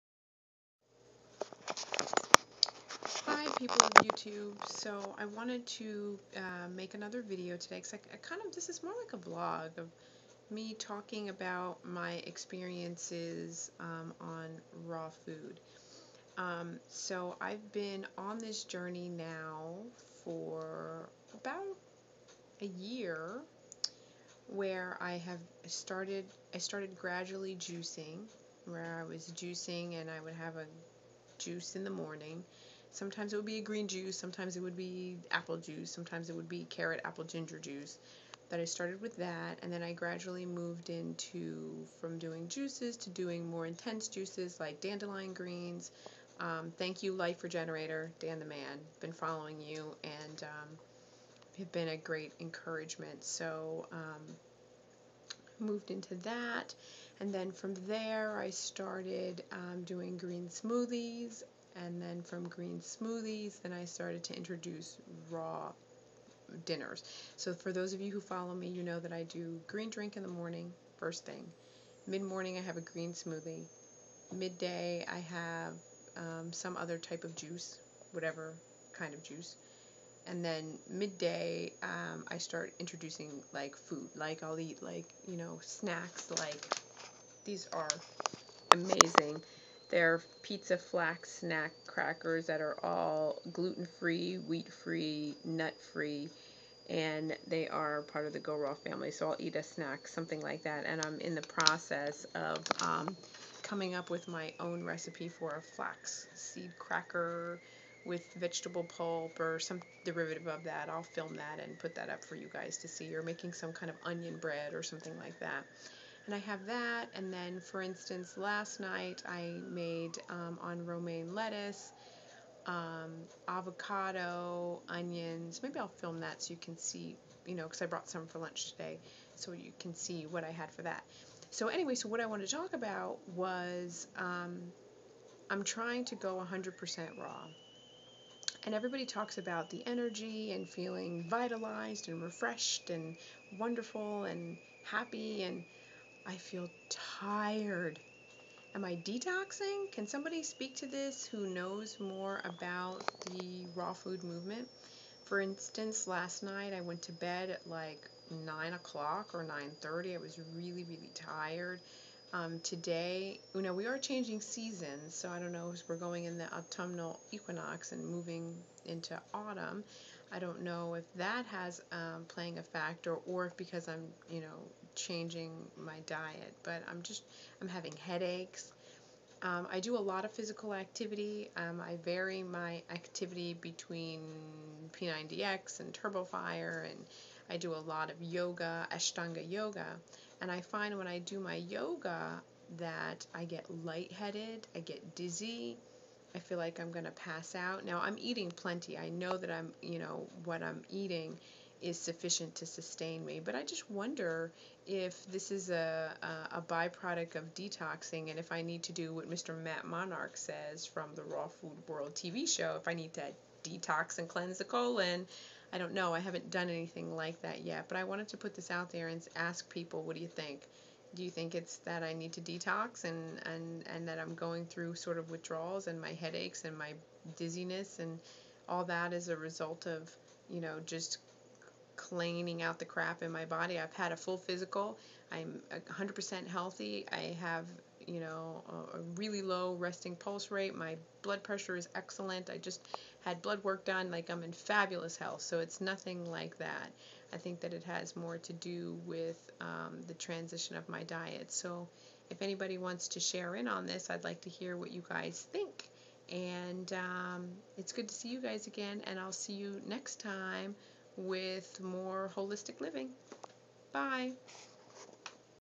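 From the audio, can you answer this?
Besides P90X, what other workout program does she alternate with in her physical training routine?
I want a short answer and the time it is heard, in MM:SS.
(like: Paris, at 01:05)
Turbofire, at 03:05.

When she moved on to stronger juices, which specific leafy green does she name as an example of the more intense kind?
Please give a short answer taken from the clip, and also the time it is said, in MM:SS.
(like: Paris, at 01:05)
dandelion greens, at 00:44.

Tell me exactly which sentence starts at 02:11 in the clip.
So anyway, so what I wanted to talk about was um, I'm trying to go 100% raw.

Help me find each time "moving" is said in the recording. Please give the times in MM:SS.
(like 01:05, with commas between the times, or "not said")
02:48.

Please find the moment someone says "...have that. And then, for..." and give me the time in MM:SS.
01:56.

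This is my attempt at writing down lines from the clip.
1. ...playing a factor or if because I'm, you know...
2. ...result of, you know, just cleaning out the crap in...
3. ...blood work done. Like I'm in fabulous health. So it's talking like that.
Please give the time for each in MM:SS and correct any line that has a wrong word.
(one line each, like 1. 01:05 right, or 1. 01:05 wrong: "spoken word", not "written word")
1. 02:52 right
2. 03:49 right
3. 04:03 wrong: "nothing", not "talking".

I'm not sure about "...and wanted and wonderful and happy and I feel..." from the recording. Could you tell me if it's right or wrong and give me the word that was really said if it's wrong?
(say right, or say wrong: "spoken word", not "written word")
wrong: "refreshed", not "wanted".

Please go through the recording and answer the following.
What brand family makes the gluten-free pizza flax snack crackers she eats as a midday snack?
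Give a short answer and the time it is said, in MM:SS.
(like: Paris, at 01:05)
Go Raw, at 01:38.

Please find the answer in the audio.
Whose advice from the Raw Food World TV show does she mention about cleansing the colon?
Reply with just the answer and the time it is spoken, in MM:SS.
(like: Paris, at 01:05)
Matt Monarch, at 03:29.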